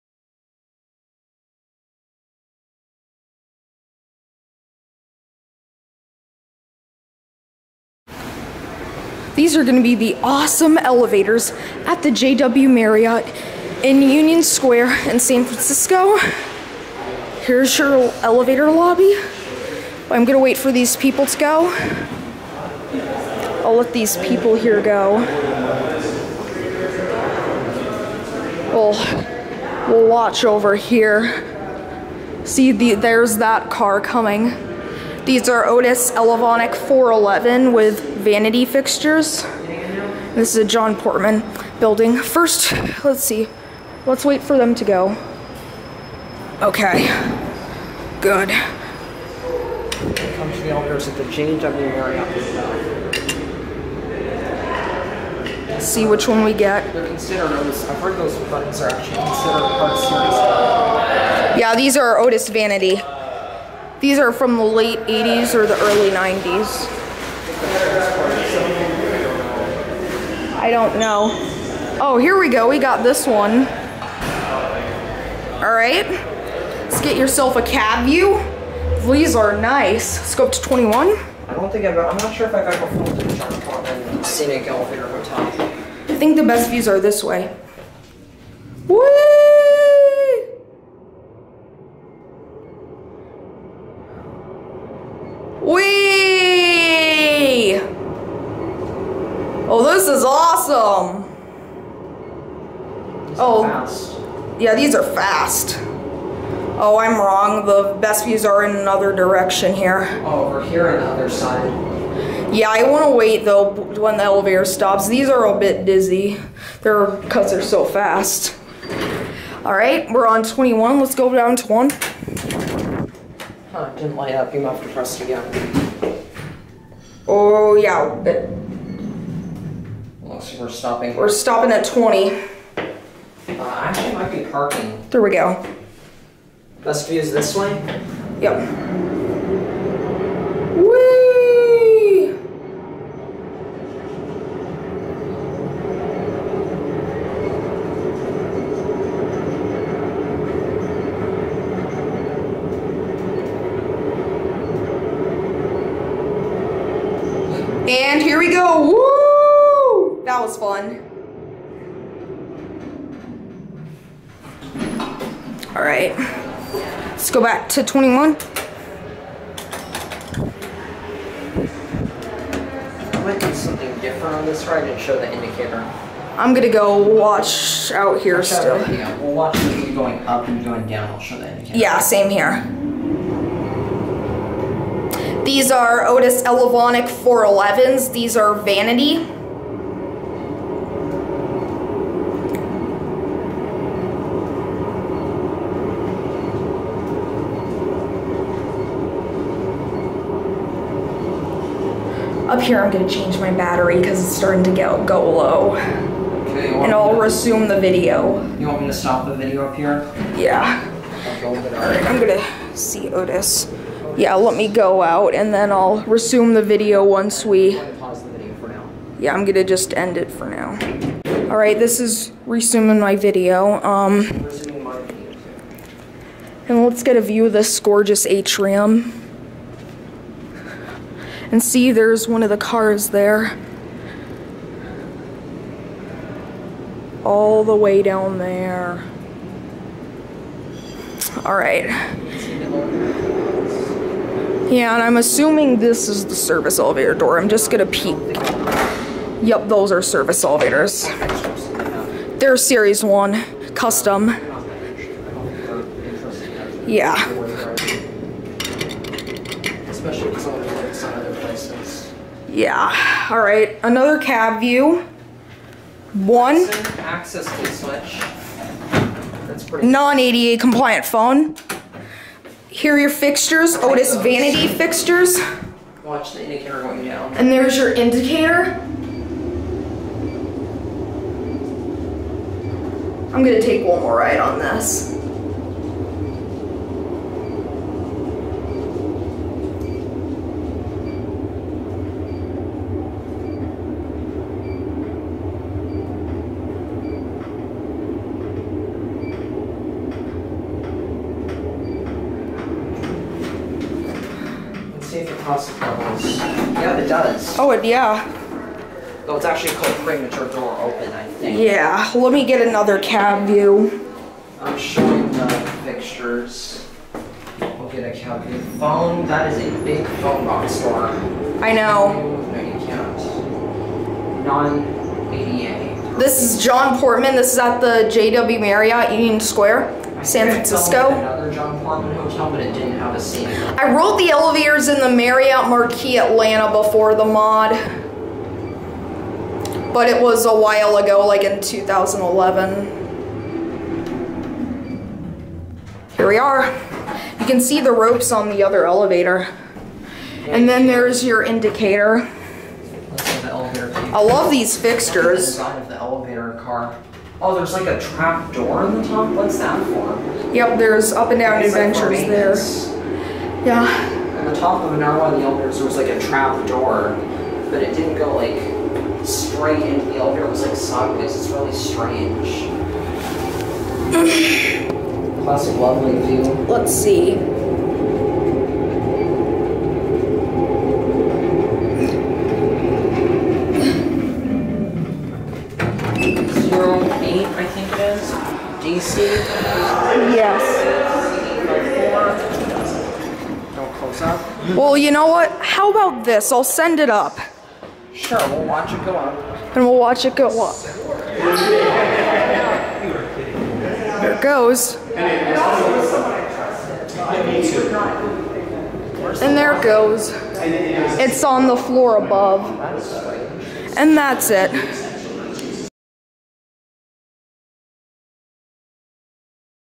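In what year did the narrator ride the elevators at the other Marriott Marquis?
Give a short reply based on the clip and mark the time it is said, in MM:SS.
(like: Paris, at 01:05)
2011, at 05:41.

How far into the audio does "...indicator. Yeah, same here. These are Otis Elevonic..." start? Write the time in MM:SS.
03:01.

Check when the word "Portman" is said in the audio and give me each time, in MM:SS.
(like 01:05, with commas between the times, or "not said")
00:40, 05:26.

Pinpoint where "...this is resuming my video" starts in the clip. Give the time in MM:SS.
03:41.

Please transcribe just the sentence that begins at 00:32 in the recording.
See, the, there's that car coming.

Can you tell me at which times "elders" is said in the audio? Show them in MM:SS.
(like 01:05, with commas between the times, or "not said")
00:50, 06:05.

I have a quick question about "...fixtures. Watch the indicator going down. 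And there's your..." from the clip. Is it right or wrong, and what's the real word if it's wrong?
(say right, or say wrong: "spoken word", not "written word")
right.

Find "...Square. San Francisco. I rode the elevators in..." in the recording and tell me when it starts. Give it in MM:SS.
05:29.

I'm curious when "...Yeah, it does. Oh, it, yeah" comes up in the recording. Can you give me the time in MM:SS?
05:05.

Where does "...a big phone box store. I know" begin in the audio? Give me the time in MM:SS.
05:19.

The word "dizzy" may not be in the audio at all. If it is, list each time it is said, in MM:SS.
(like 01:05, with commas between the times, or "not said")
01:55.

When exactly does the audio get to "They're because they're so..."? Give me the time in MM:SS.
01:56.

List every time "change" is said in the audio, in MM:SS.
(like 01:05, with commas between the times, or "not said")
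00:51, 03:23.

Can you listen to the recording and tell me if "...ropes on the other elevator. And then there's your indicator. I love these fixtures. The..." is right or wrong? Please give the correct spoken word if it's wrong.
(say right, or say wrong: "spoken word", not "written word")
right.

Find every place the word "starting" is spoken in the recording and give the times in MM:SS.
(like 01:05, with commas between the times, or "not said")
03:24.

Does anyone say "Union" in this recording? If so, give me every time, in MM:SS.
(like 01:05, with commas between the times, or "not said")
00:14, 05:29.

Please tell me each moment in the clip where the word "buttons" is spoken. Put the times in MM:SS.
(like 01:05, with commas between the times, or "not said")
00:58.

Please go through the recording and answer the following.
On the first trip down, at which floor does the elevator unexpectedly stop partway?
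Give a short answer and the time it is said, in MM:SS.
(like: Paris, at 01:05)
20, at 02:11.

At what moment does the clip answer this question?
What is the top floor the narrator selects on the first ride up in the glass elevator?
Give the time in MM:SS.
01:20.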